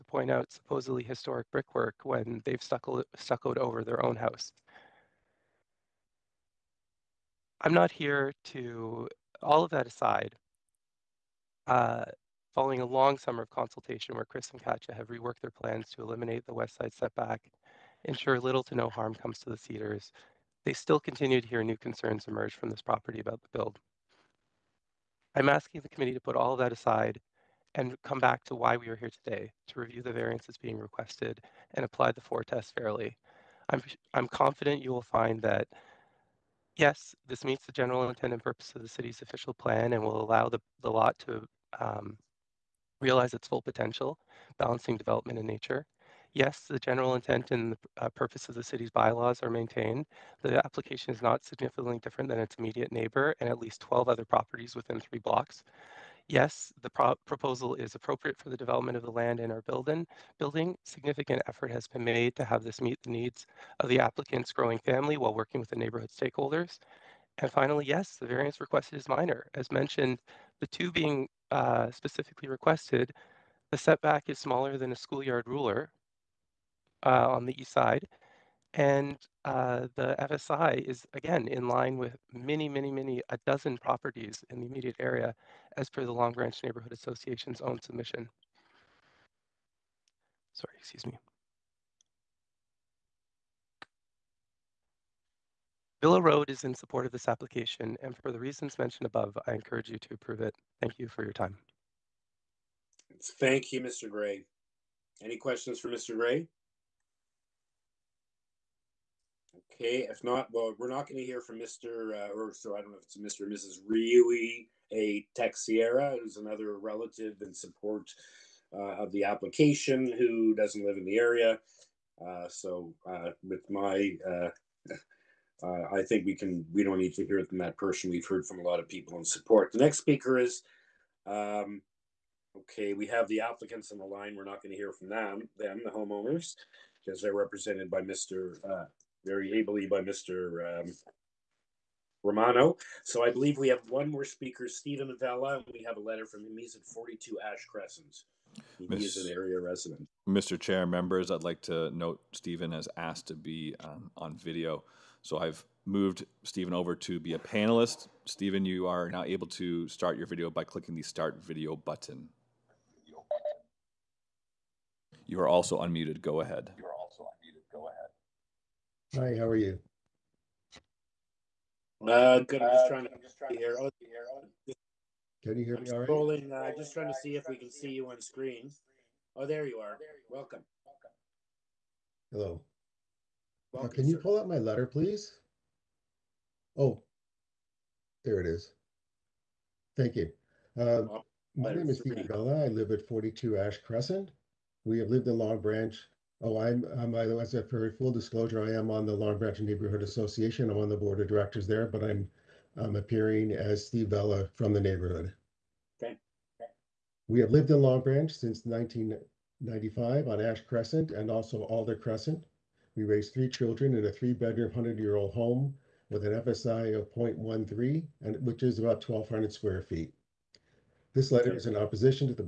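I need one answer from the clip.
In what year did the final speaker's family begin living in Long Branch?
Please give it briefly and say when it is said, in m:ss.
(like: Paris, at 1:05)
1995, at 3:28.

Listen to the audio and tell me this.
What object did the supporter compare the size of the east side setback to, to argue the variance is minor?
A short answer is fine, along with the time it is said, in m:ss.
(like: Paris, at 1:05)
a schoolyard ruler, at 1:14.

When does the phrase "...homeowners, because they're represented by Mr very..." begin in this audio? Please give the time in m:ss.
2:15.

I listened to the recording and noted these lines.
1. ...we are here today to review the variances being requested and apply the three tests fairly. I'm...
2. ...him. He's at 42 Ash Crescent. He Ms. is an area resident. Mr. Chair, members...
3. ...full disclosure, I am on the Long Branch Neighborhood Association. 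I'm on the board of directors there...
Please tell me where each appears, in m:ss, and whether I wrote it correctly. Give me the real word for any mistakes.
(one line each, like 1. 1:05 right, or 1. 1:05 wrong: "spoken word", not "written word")
1. 0:28 wrong: "four", not "three"
2. 2:26 right
3. 3:17 right.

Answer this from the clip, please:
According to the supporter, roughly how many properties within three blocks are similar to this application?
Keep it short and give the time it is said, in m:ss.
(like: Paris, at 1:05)
12, at 0:53.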